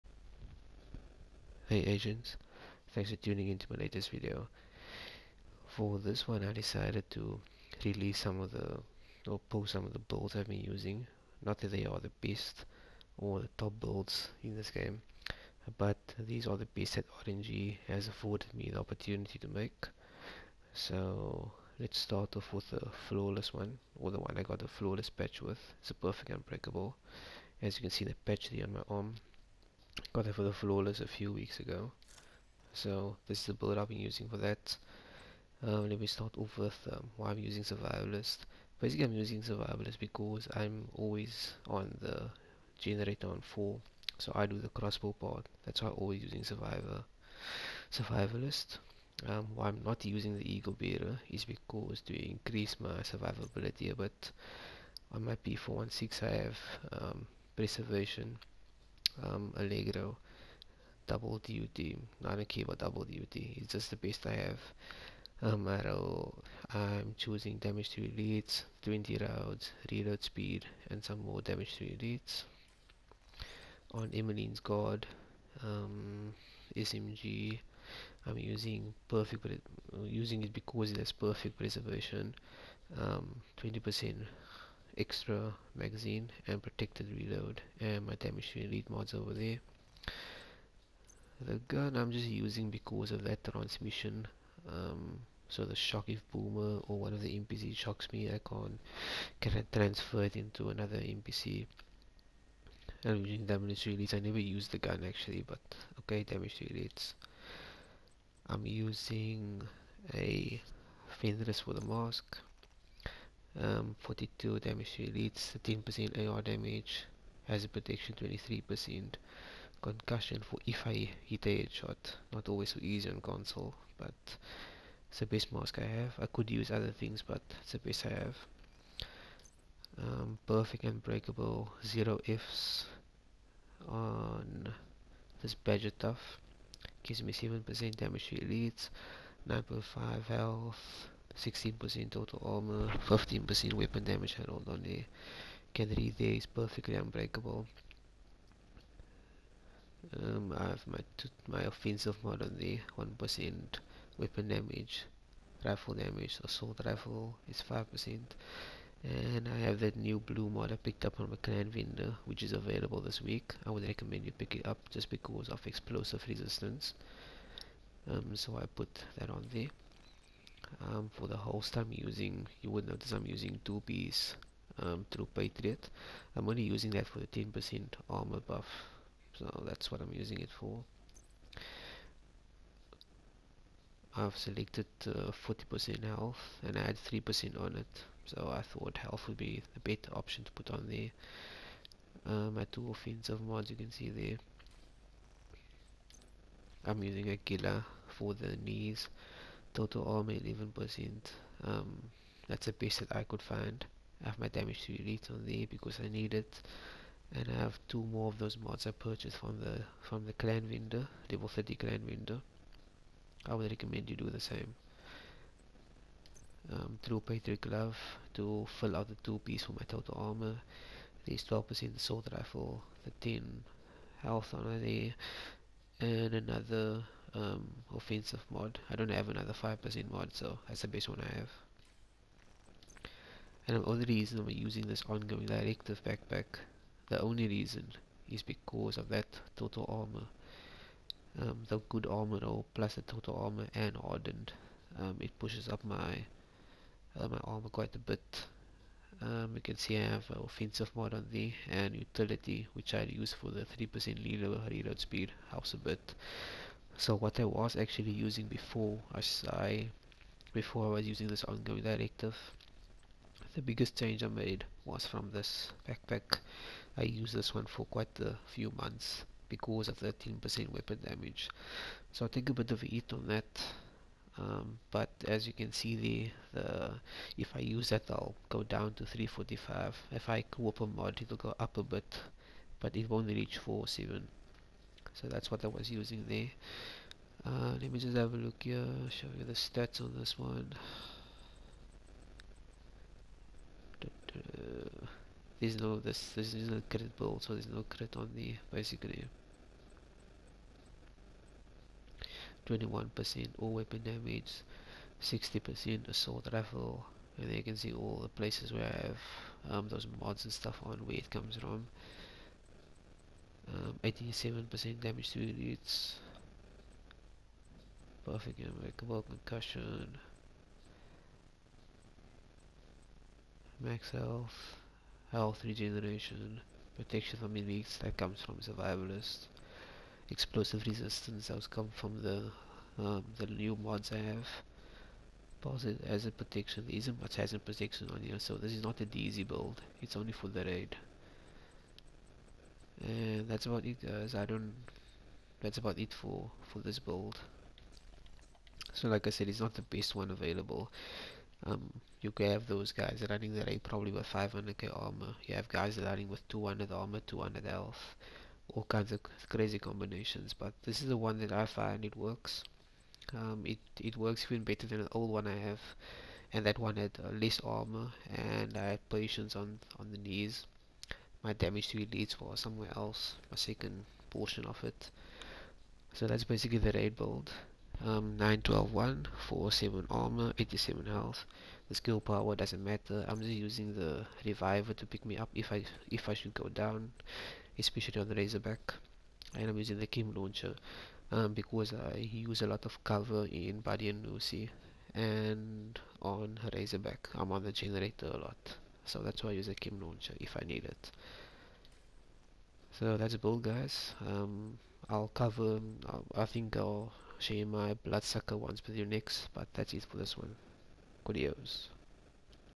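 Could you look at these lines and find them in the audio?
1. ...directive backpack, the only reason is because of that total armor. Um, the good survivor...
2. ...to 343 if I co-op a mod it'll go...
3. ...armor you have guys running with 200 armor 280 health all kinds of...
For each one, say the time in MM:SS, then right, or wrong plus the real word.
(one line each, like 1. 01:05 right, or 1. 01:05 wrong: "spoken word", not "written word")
1. 03:55 wrong: "armor", not "survivor"
2. 04:38 wrong: "345", not "343"
3. 05:54 wrong: "200", not "280".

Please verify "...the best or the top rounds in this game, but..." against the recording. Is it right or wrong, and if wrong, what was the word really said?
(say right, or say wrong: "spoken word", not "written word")
wrong: "builds", not "rounds".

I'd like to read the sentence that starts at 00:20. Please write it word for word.
So let's start off with the flawless one, or the one I got the flawless patch with.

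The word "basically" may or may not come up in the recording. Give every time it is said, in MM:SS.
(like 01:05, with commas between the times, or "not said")
00:38, 04:58, 06:16.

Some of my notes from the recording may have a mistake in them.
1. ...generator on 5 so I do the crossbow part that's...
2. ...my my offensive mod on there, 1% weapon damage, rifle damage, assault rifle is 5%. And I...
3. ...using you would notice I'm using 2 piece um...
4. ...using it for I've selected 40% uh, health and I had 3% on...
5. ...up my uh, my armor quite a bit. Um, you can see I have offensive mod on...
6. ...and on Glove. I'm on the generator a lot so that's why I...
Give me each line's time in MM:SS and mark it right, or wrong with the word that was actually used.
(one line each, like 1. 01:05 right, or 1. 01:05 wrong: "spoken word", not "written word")
1. 00:42 wrong: "4", not "5"
2. 02:30 right
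3. 02:51 right
4. 03:00 right
5. 04:05 right
6. 06:35 wrong: "Razorback", not "Glove".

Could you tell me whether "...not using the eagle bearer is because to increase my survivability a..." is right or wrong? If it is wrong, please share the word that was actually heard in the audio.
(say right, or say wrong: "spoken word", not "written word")
right.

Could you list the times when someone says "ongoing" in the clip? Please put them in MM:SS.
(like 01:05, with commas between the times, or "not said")
03:55, 04:21.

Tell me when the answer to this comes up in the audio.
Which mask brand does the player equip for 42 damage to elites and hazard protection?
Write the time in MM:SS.
01:51.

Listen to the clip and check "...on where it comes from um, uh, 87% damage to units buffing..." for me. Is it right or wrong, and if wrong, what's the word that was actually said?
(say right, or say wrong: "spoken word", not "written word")
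right.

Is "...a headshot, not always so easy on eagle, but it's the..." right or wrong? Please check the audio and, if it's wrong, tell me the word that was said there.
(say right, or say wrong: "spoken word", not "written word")
wrong: "console", not "eagle".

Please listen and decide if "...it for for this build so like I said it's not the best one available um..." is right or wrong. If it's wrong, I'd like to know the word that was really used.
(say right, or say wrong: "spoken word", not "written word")
right.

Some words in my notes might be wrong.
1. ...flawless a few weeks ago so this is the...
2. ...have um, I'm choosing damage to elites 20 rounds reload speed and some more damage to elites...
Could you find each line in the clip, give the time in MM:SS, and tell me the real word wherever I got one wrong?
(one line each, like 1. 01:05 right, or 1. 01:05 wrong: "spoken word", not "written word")
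1. 00:30 right
2. 01:04 right.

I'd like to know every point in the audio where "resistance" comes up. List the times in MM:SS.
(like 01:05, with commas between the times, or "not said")
02:46, 05:30.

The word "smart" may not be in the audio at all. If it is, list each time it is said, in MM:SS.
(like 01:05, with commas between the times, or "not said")
not said.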